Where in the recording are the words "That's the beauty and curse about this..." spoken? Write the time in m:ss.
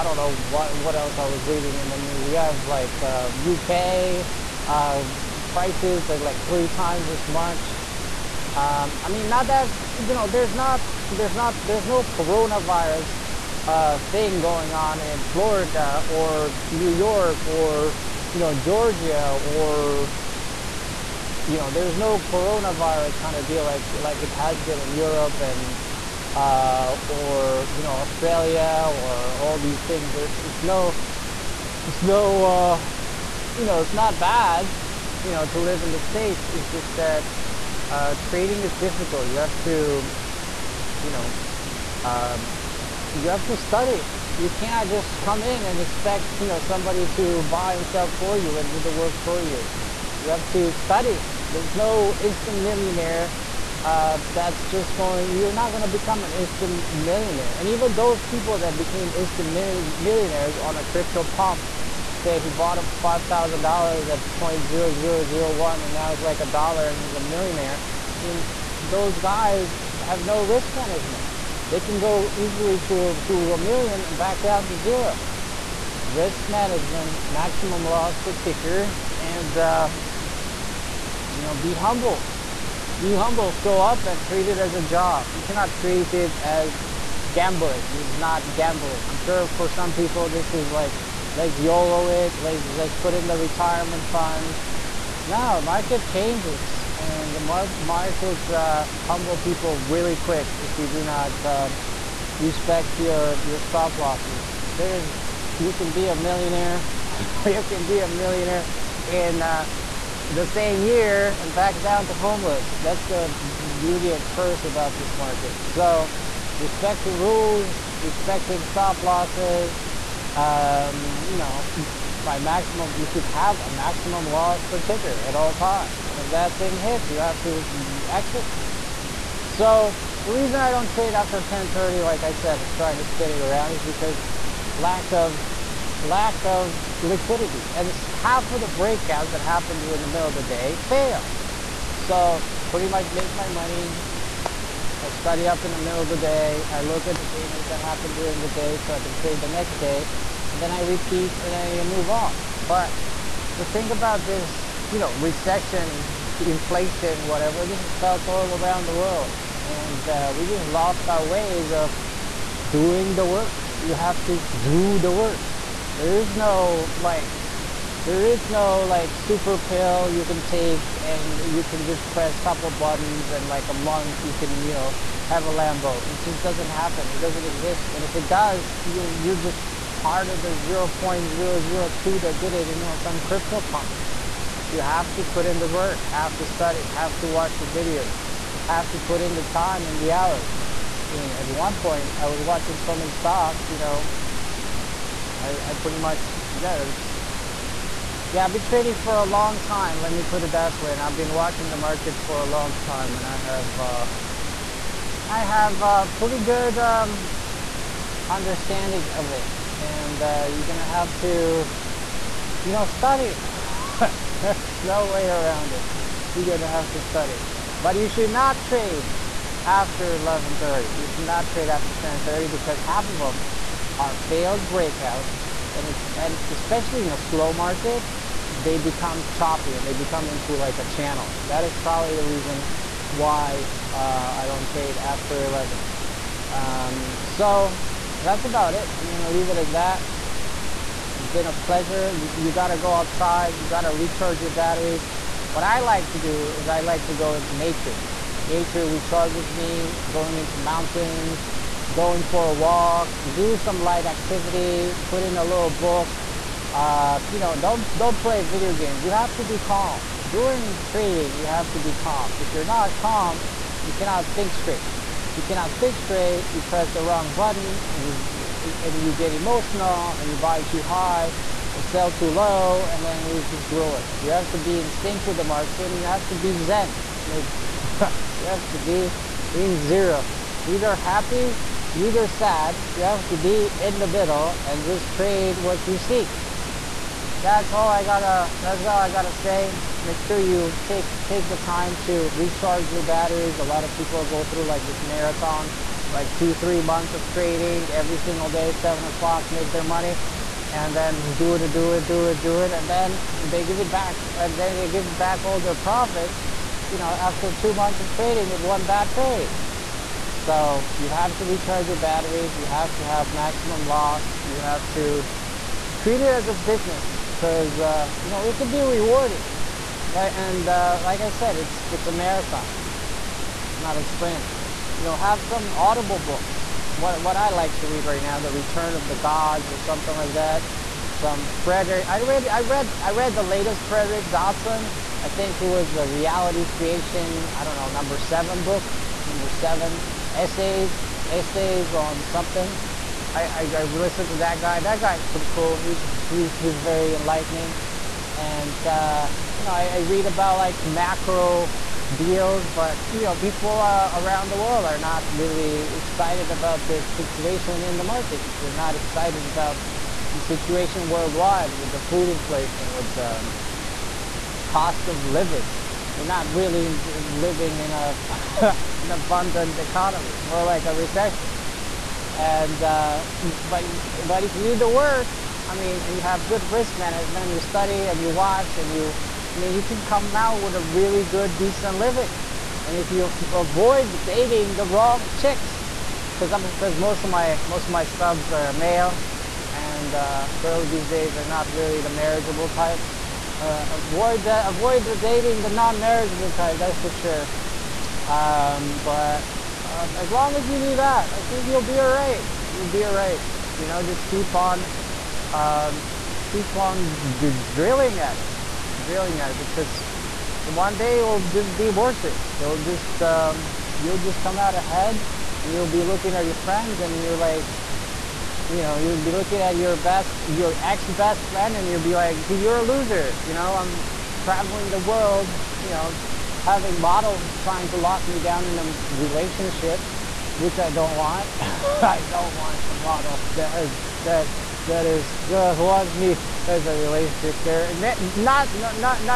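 1:52.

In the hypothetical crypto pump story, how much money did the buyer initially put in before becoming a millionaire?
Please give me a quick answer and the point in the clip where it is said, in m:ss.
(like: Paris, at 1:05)
$5,000, at 1:03.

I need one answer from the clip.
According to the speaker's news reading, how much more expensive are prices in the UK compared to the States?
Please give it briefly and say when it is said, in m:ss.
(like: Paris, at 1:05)
3 times, at 0:06.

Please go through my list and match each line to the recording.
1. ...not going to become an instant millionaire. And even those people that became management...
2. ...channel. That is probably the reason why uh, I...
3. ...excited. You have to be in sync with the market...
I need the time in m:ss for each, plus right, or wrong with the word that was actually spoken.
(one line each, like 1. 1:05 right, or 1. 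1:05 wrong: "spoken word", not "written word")
1. 0:55 wrong: "instant", not "management"
2. 3:50 right
3. 4:33 wrong: "ruined", not "excited".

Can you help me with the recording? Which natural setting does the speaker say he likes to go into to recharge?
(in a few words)
Mountains.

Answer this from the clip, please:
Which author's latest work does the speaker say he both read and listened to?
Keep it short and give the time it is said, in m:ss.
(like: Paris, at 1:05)
Frederick Dodson, at 5:33.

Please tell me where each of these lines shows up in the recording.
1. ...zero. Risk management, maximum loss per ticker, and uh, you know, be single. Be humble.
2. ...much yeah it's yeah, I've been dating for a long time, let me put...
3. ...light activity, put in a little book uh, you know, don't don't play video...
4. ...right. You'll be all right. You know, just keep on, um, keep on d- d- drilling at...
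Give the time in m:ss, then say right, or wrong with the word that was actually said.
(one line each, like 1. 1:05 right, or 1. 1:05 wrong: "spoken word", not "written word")
1. 1:14 wrong: "humble", not "single"
2. 3:15 wrong: "trading", not "dating"
3. 4:13 right
4. 6:42 right.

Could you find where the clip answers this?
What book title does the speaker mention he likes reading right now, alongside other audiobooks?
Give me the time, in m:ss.
5:28.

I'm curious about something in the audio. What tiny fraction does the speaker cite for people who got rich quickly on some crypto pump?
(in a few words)
0.002.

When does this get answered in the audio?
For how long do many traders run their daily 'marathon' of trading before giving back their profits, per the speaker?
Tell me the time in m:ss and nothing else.
4:56.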